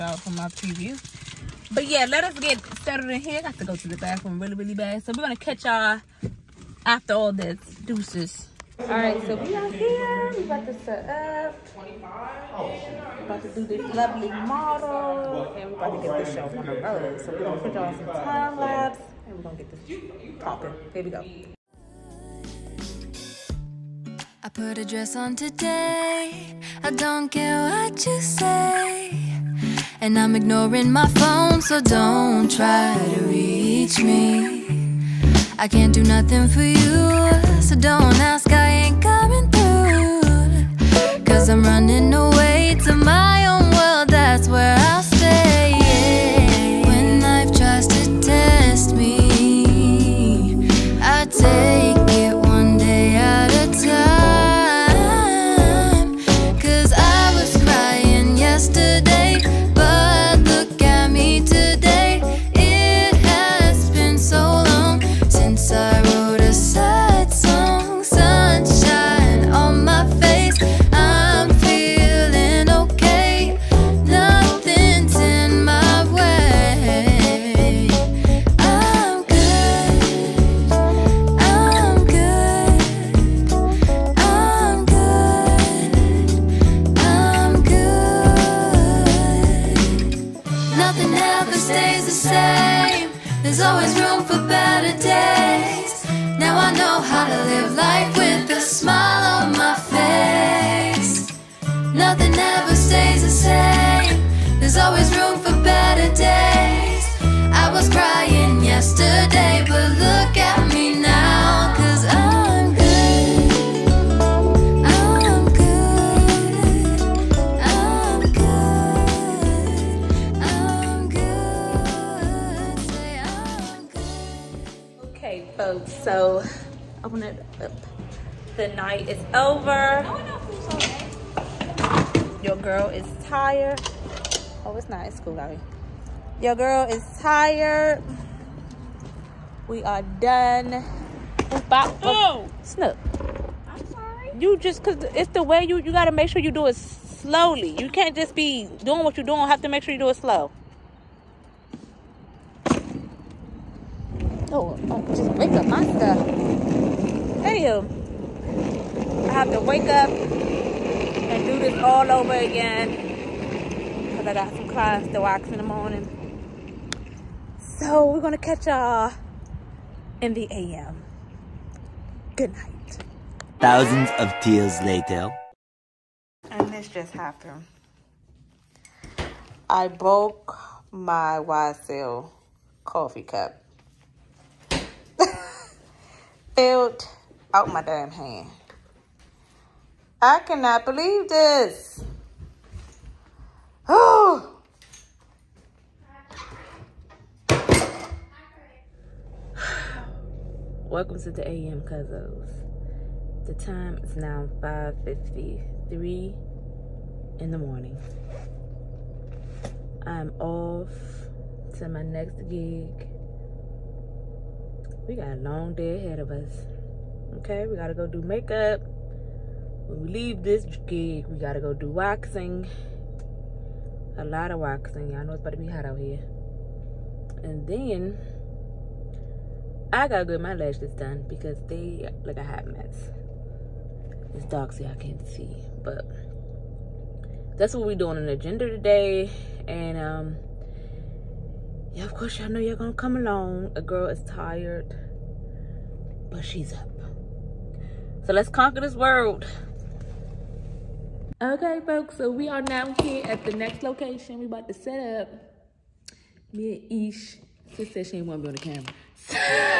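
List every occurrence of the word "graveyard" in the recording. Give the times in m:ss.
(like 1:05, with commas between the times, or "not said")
not said.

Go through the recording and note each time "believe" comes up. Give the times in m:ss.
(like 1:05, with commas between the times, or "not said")
3:10.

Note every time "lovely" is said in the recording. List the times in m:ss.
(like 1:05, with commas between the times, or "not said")
0:13.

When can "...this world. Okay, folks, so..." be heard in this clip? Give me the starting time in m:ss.
4:08.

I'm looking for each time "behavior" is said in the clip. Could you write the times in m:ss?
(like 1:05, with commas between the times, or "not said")
not said.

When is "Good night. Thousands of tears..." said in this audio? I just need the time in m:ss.
2:52.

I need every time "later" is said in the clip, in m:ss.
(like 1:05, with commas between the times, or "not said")
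2:54.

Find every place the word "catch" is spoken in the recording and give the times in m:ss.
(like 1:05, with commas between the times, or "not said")
0:05, 2:48.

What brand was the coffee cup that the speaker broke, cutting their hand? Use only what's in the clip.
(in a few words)
YSL.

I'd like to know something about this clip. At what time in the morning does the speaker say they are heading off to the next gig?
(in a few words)
5:53.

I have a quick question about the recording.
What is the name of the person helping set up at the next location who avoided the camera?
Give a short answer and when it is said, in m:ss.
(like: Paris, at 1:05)
Ish, at 4:17.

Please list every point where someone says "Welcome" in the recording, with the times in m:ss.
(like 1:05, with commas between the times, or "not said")
3:20.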